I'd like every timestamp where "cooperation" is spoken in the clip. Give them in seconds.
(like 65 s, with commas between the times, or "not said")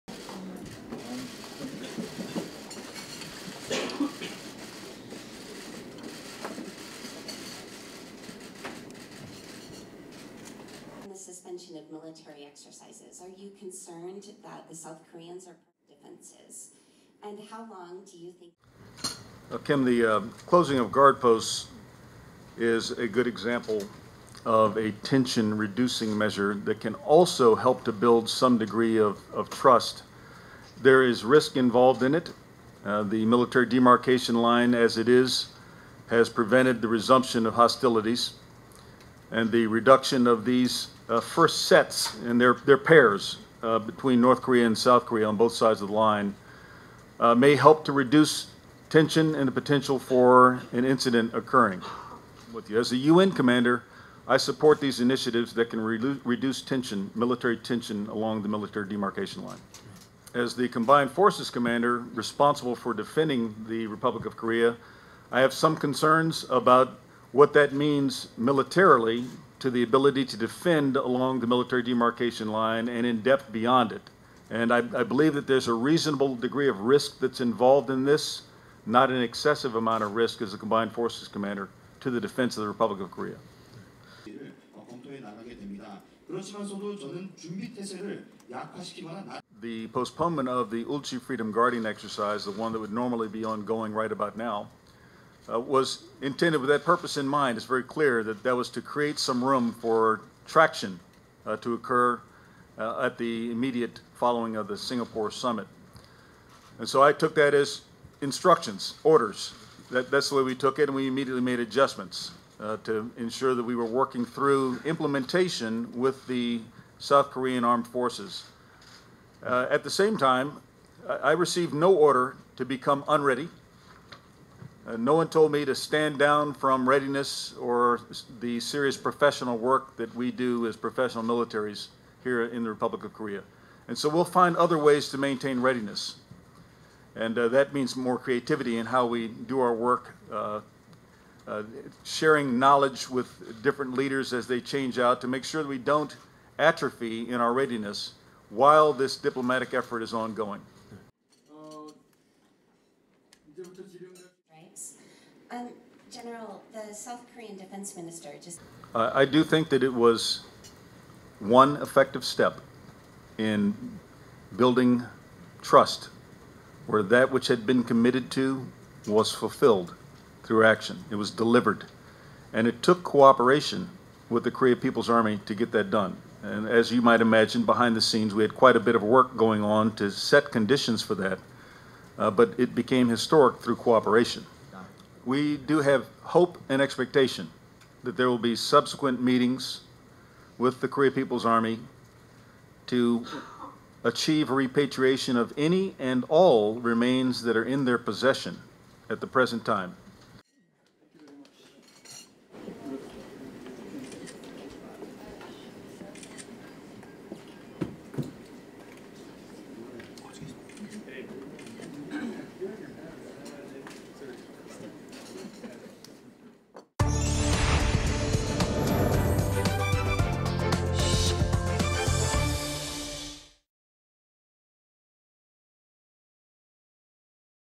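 173 s, 183 s.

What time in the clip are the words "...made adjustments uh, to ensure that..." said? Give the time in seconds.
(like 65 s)
111 s.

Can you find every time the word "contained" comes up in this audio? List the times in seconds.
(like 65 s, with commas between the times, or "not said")
not said.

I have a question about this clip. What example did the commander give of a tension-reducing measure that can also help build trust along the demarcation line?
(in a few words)
closing of guard posts.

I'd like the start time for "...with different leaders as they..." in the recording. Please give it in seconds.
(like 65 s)
143 s.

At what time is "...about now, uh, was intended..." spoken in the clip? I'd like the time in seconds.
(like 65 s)
94 s.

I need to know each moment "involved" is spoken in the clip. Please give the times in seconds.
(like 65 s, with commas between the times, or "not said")
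31 s, 77 s.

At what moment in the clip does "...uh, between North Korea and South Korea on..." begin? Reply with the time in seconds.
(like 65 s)
43 s.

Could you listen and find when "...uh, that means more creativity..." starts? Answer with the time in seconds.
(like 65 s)
137 s.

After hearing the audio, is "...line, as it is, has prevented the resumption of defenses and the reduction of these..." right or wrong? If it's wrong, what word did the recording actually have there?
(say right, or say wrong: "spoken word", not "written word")
wrong: "hostilities", not "defenses".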